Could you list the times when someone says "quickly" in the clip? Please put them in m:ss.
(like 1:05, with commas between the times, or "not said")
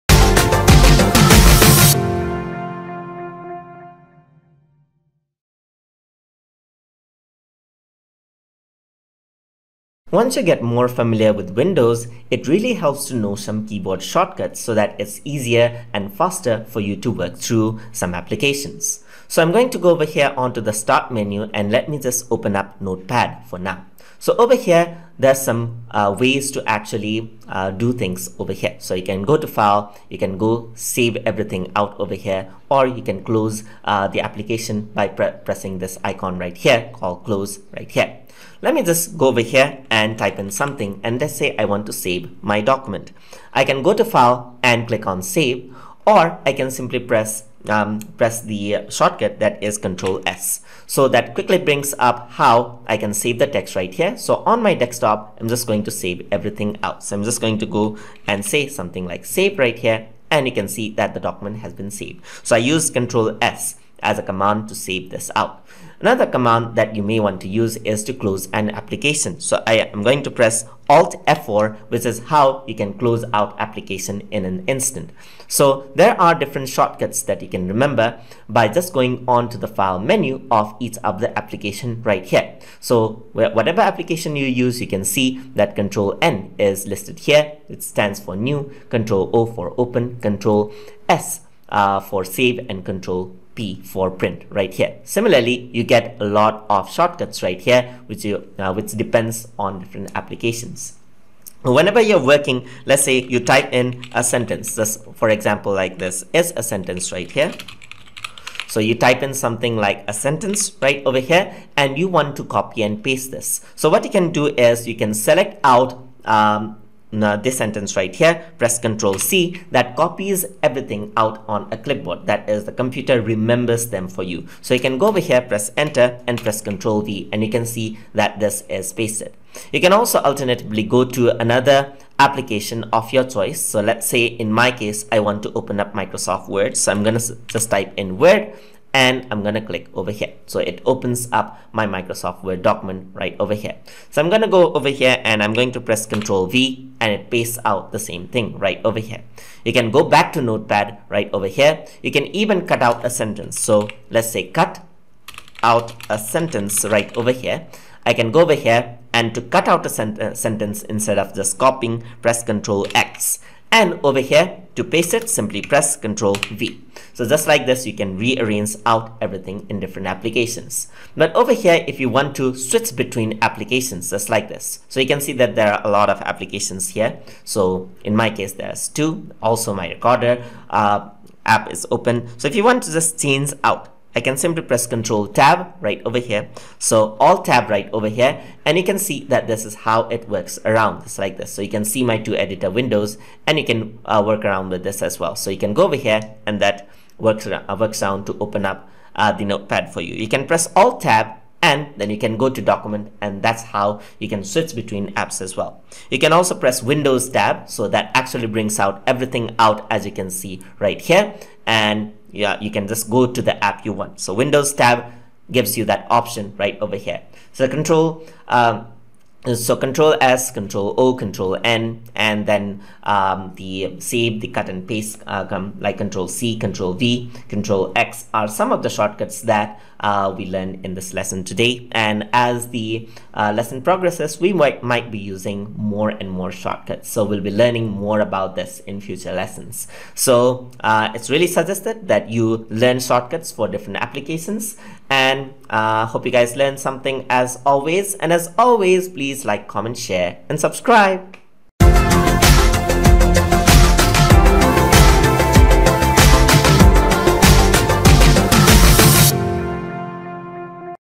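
0:51.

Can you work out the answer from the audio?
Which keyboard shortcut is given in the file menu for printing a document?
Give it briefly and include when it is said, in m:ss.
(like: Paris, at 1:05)
Control P, at 1:32.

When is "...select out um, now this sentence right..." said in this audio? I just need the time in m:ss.
1:55.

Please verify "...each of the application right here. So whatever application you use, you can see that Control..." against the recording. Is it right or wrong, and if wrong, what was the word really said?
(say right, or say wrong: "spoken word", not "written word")
right.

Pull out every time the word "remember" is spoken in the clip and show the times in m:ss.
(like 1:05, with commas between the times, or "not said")
1:17, 2:03.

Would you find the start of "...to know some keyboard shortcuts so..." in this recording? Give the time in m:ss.
0:13.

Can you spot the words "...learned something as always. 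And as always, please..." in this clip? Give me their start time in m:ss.
4:06.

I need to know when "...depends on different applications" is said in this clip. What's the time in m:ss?
1:38.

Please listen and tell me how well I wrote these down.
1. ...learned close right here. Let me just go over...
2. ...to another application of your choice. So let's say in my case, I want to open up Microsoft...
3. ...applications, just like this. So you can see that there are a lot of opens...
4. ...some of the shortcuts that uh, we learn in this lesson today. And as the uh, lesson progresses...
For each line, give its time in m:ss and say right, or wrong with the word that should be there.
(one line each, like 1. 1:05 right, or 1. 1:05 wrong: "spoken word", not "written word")
1. 0:36 wrong: "called", not "learned"
2. 2:11 right
3. 2:53 wrong: "applications", not "opens"
4. 3:48 right.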